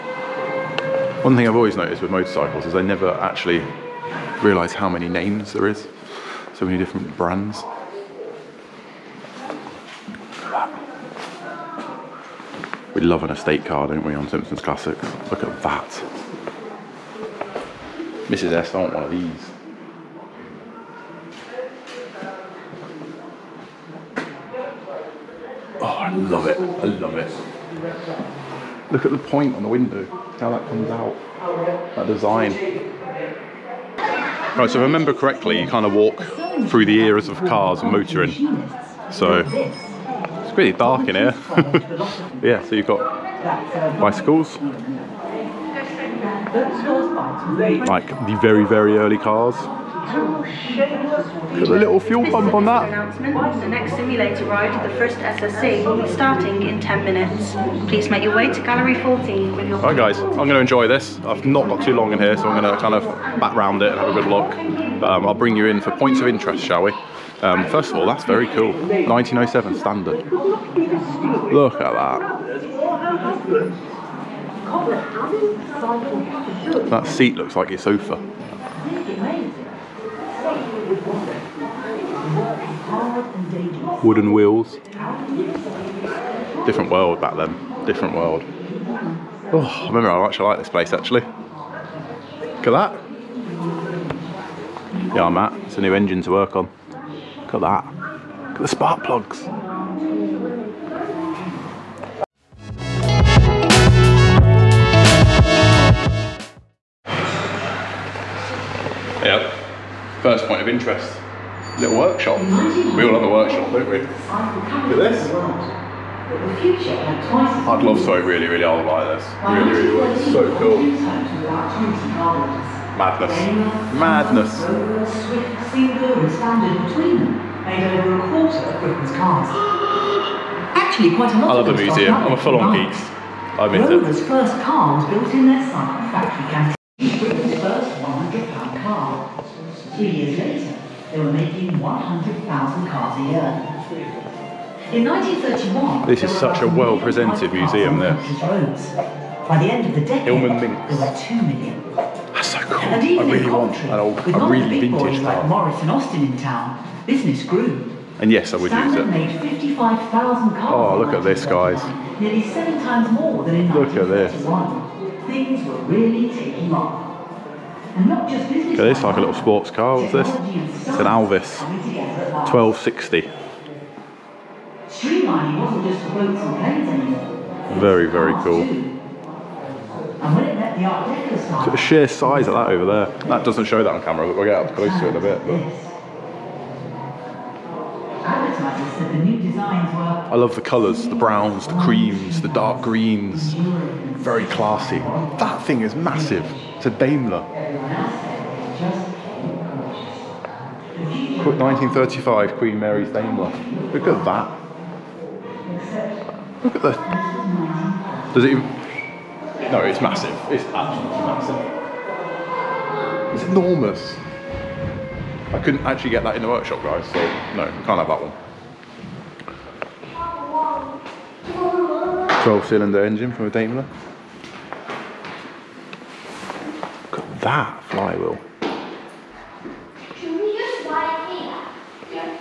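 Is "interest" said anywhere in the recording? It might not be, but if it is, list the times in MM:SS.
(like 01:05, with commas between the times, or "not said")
01:06, 01:50.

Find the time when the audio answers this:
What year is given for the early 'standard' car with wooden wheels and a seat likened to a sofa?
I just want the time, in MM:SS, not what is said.
01:08.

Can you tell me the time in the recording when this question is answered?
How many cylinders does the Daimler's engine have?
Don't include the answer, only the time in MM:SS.
03:42.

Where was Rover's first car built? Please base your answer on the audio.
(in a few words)
cycle factory canteen.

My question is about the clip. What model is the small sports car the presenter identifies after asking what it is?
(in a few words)
Alvis 1260.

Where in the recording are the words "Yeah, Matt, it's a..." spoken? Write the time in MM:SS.
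01:35.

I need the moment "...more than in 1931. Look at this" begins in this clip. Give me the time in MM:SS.
02:43.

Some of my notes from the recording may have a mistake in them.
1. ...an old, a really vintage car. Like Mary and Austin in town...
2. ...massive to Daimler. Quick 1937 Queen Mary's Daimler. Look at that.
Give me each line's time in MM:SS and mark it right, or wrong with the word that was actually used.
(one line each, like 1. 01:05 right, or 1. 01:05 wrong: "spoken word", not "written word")
1. 02:33 wrong: "Morris", not "Mary"
2. 03:15 wrong: "1935", not "1937".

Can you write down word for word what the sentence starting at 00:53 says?
The next simulator ride, the first SSC, will be starting in 10 minutes.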